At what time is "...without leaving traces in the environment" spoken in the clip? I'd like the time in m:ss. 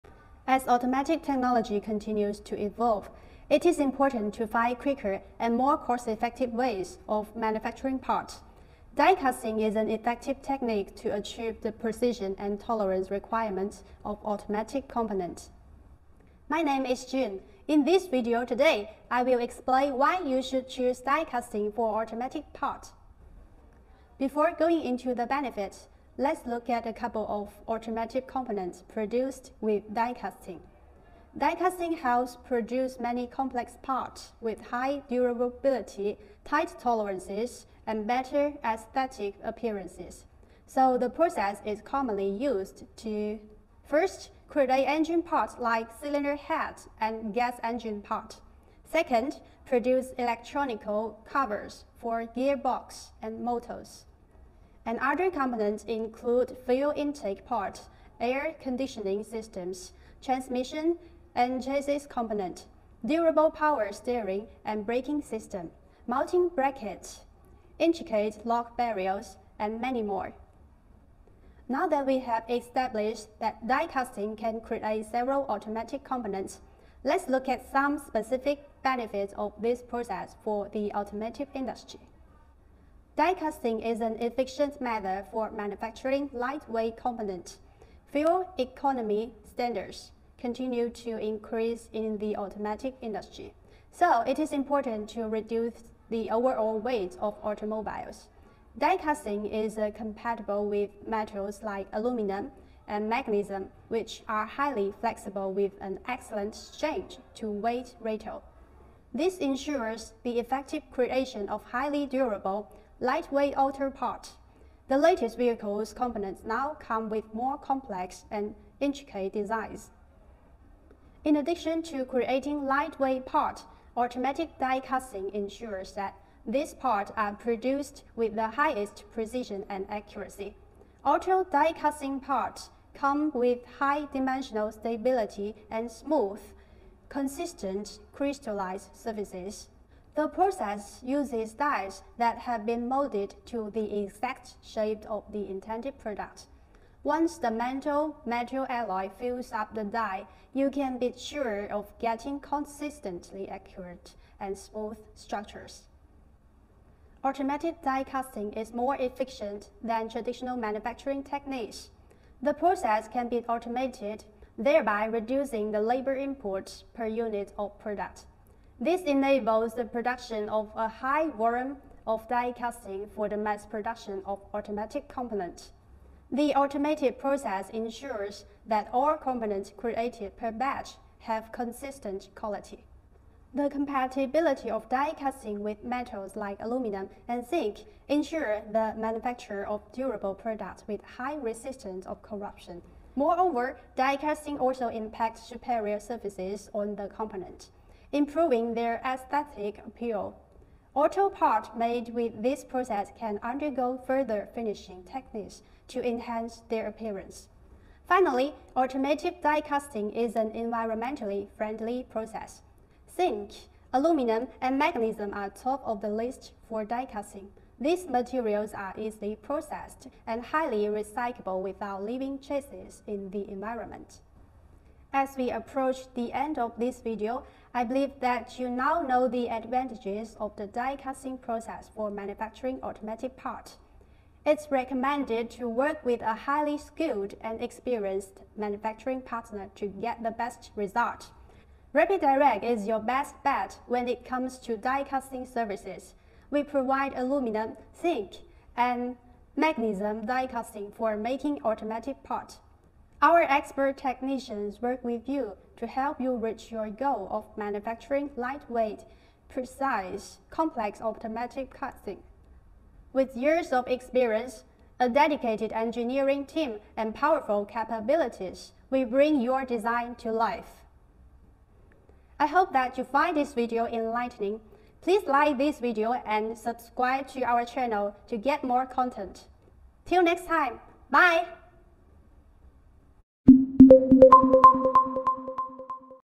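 3:41.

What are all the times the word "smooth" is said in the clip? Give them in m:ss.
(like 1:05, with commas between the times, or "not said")
2:15, 2:34.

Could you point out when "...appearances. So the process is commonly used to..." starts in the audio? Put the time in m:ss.
0:39.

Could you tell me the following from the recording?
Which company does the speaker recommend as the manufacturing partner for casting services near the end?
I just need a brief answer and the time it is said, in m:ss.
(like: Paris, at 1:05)
RapidDirect, at 4:01.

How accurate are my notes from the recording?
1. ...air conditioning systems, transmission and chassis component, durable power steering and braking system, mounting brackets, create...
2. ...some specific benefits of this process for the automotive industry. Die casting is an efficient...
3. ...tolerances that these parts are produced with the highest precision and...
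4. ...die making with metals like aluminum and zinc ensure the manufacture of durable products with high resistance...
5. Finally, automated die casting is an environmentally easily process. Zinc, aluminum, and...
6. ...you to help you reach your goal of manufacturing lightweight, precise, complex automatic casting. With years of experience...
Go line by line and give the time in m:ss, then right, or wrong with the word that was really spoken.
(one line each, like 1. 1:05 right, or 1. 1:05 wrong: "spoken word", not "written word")
1. 0:58 wrong: "intricate", not "create"
2. 1:17 right
3. 2:05 wrong: "ensures", not "tolerances"
4. 3:04 wrong: "casting", not "making"
5. 3:28 wrong: "friendly", not "easily"
6. 4:15 right.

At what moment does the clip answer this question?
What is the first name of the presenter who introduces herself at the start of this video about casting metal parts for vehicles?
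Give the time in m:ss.
0:17.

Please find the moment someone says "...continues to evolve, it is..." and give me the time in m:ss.
0:01.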